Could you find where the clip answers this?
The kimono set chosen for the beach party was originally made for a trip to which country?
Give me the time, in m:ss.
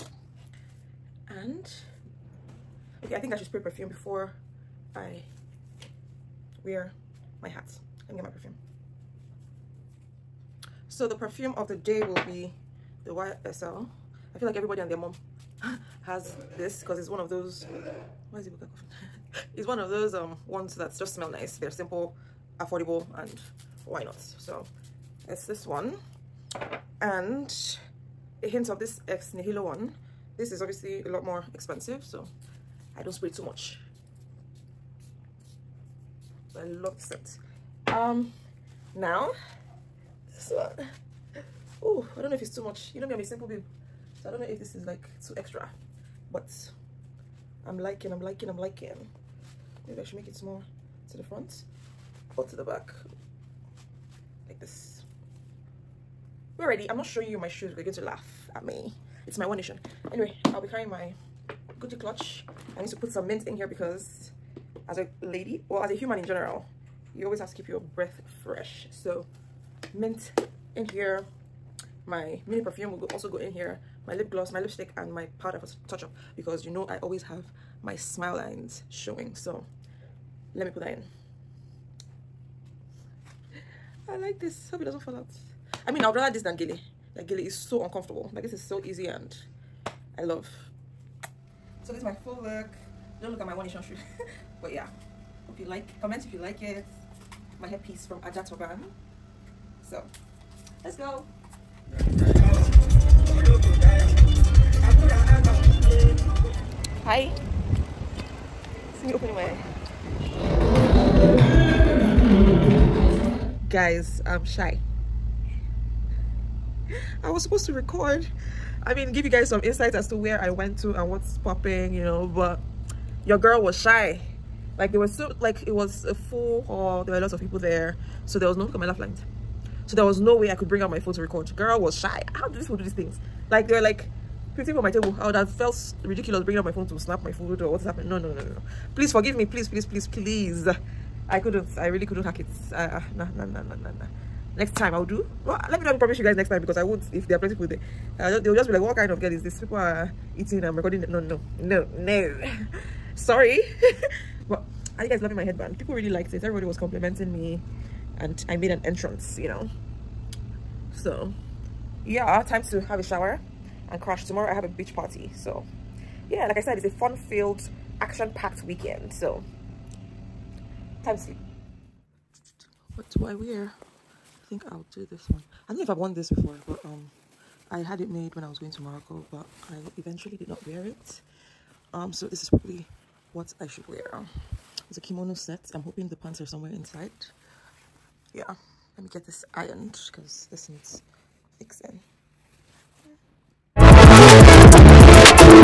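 2:58.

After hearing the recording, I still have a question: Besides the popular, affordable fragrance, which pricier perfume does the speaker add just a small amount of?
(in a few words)
Ex Nihilo.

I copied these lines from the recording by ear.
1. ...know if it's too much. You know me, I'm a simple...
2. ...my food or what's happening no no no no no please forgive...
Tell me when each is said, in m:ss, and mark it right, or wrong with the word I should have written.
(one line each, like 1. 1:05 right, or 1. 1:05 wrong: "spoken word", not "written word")
1. 0:42 right
2. 2:17 right.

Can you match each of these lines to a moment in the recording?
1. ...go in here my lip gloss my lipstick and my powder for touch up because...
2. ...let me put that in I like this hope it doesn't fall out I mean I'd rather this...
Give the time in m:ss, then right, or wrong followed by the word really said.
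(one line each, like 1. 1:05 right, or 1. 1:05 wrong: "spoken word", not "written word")
1. 1:13 right
2. 1:20 right.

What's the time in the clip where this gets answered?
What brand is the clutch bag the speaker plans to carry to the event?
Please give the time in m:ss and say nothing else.
1:01.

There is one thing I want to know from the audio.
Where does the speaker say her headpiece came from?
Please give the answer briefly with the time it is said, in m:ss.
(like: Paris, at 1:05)
Ajatoban, at 1:38.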